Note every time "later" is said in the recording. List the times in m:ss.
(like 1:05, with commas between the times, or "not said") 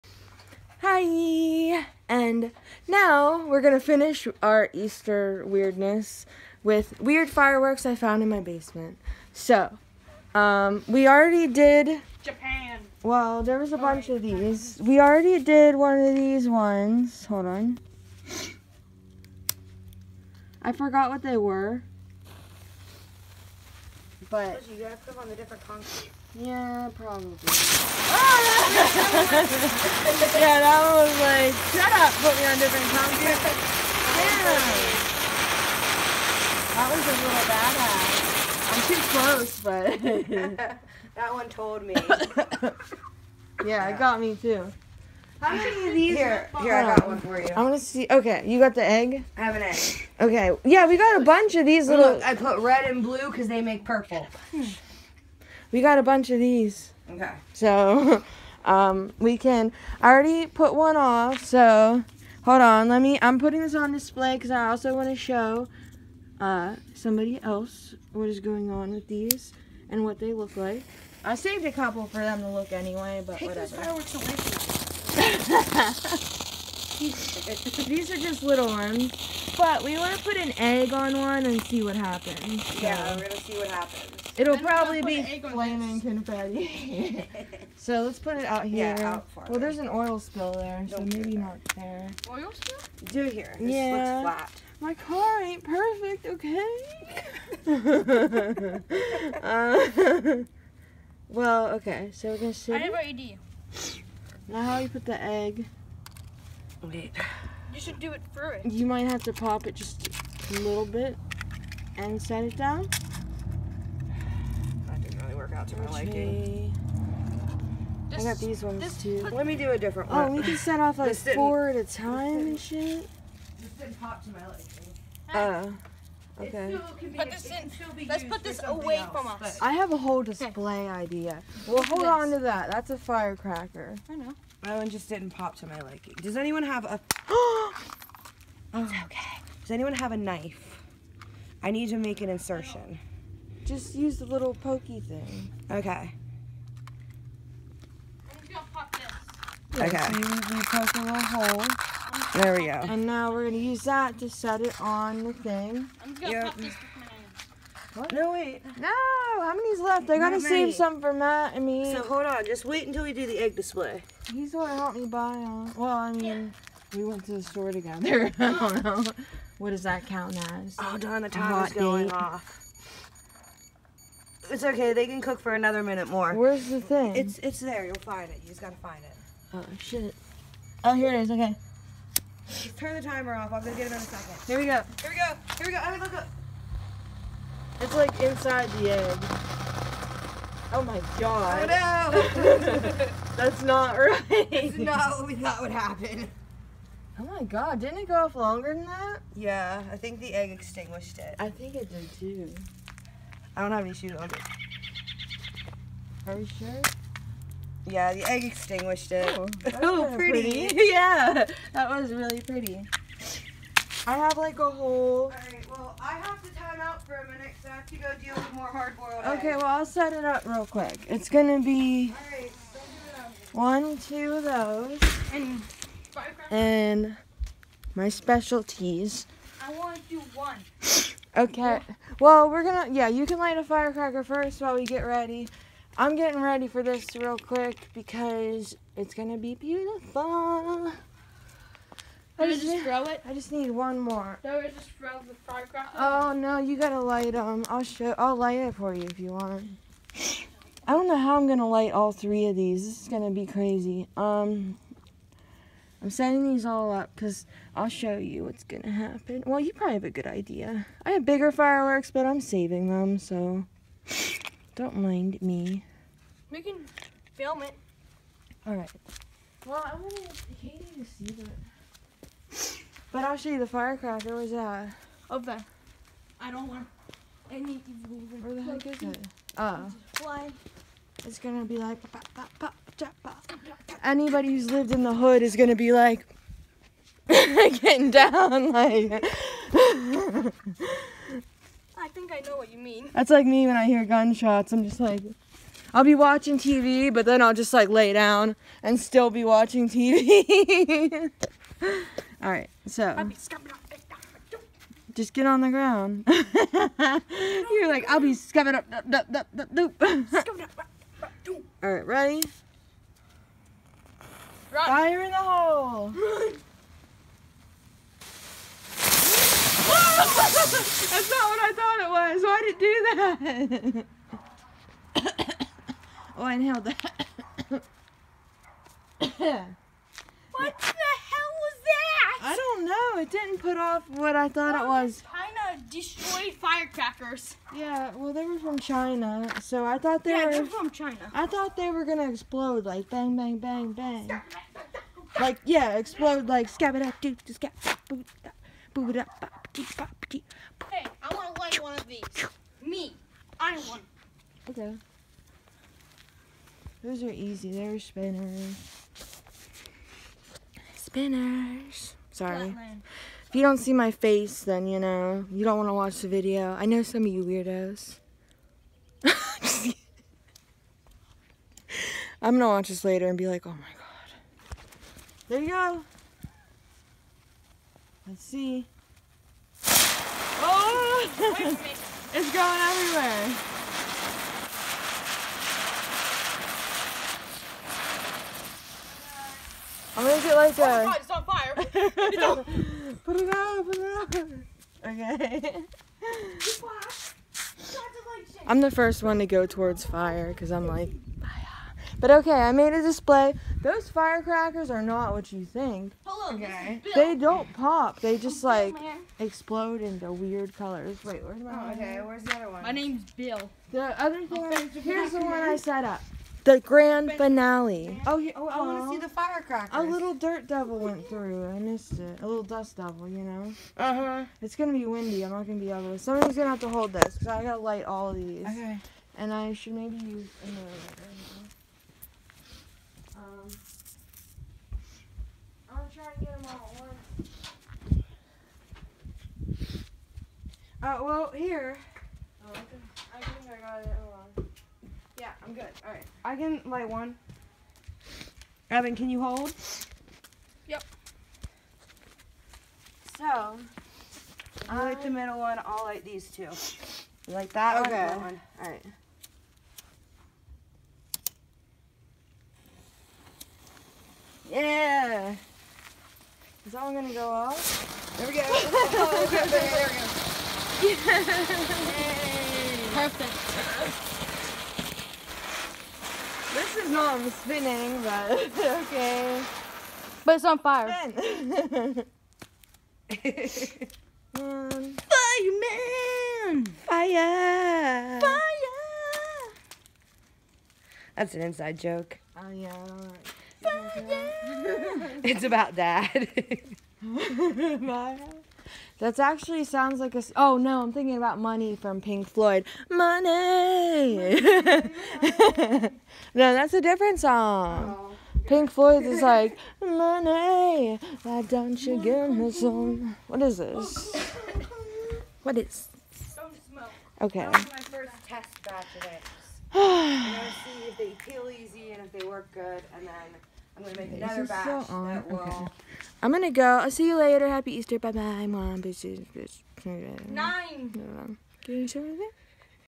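6:13, 8:47.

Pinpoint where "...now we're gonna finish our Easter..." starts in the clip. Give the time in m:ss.
0:02.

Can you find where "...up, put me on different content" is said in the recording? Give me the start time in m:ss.
0:31.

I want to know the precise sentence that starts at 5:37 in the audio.
Yeah, well, they were from China, so I thought they yeah, were.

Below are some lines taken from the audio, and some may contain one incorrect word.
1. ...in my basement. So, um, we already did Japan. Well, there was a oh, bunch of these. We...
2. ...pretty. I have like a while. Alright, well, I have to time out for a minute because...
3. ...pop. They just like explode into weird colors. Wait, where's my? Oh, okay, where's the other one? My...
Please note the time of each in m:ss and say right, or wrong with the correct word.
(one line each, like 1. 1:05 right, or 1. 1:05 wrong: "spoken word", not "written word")
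1. 0:08 right
2. 3:32 wrong: "whole", not "while"
3. 6:47 right.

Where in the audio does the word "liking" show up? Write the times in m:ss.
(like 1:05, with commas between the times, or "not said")
1:55, 2:04, 2:15.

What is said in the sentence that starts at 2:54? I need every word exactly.
They can cook for another minute more.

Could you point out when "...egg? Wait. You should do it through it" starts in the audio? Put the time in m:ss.
1:45.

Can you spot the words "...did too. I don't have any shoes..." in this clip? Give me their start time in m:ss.
3:21.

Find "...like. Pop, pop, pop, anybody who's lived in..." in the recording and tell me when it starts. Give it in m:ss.
4:41.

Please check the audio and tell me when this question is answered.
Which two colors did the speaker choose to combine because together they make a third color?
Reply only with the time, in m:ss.
0:52.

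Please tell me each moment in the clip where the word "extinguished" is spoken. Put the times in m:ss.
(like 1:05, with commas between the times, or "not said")
3:20, 3:28.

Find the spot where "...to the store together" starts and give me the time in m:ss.
2:47.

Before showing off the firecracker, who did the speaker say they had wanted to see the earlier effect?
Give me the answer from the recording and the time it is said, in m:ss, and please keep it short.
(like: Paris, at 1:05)
Katie, at 4:30.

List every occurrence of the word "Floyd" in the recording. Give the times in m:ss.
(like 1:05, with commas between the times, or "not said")
8:22, 8:28.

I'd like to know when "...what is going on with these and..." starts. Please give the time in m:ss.
1:08.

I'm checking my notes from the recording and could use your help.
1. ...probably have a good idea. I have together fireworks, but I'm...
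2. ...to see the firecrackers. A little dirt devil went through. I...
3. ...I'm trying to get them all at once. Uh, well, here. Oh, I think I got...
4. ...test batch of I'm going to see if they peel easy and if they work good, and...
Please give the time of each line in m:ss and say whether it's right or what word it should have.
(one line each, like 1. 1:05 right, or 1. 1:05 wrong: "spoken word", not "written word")
1. 4:19 wrong: "bigger", not "together"
2. 6:59 right
3. 7:15 right
4. 8:38 right.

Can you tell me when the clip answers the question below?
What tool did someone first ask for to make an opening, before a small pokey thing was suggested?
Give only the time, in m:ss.
2:20.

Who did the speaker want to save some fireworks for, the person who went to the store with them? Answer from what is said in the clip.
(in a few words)
Matt.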